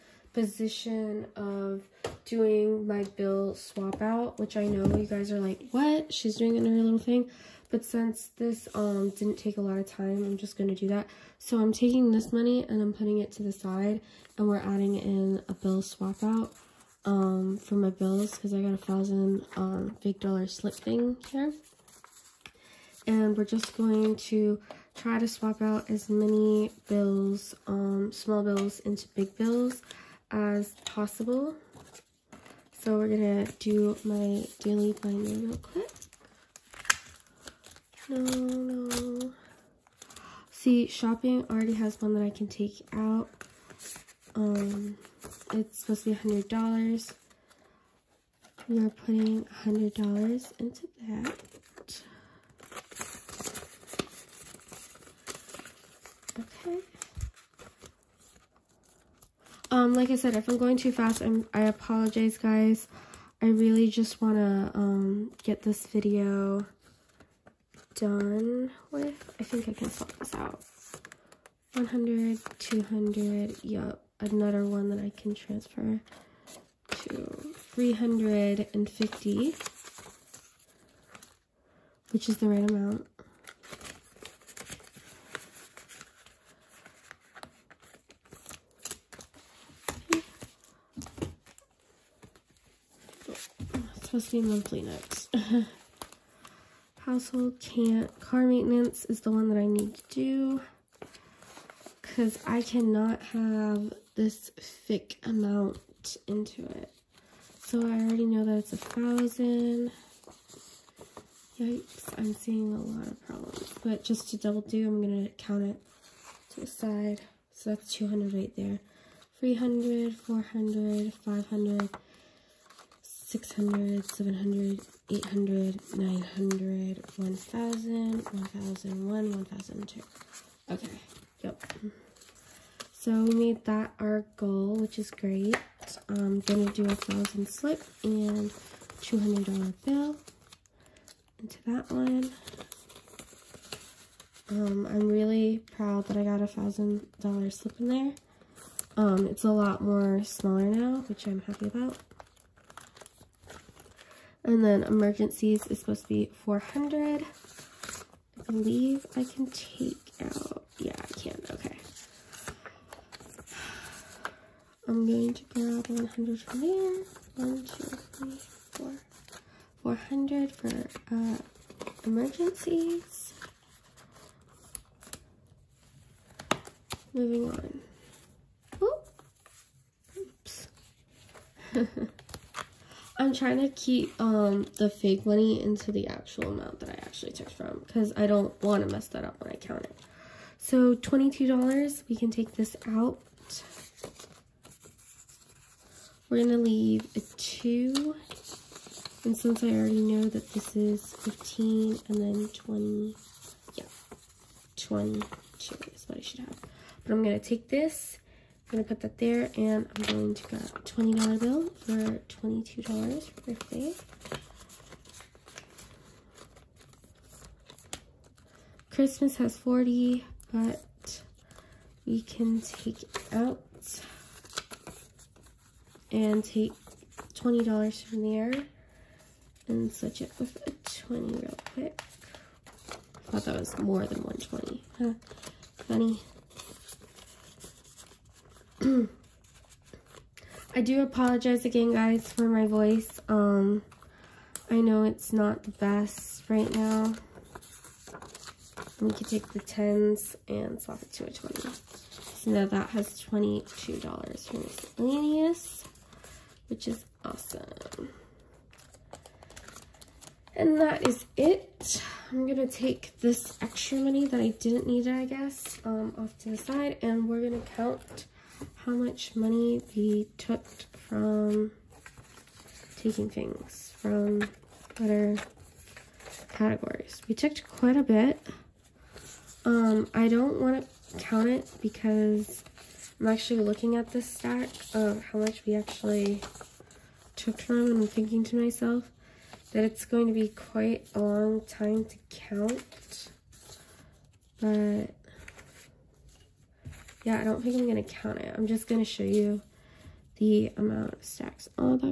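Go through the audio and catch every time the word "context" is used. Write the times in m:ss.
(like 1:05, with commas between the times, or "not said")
not said.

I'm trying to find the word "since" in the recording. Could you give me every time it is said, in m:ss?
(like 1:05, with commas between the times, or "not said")
0:07, 3:19.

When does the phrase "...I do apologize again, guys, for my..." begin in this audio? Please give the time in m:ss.
4:00.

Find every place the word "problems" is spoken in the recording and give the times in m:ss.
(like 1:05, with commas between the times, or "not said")
1:53.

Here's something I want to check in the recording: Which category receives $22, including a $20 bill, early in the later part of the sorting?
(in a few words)
Birthday.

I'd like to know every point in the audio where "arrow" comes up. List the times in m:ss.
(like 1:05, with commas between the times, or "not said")
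not said.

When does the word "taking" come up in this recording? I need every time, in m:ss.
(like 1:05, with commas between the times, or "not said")
0:11, 4:33.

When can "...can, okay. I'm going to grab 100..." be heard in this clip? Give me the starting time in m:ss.
2:41.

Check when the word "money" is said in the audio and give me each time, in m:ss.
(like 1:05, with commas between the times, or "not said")
0:12, 3:05, 4:23, 4:29.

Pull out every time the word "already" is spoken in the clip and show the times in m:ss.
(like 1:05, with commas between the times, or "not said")
0:41, 1:48, 3:19.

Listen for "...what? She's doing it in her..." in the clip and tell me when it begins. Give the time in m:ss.
0:05.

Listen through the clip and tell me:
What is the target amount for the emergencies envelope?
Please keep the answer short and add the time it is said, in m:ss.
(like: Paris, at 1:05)
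400, at 2:35.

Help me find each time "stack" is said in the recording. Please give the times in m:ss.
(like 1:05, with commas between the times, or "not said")
4:44, 5:01.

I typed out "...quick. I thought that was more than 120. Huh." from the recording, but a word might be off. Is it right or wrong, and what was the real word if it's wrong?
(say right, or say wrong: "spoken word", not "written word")
right.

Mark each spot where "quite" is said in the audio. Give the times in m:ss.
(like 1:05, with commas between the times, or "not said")
4:37, 4:50.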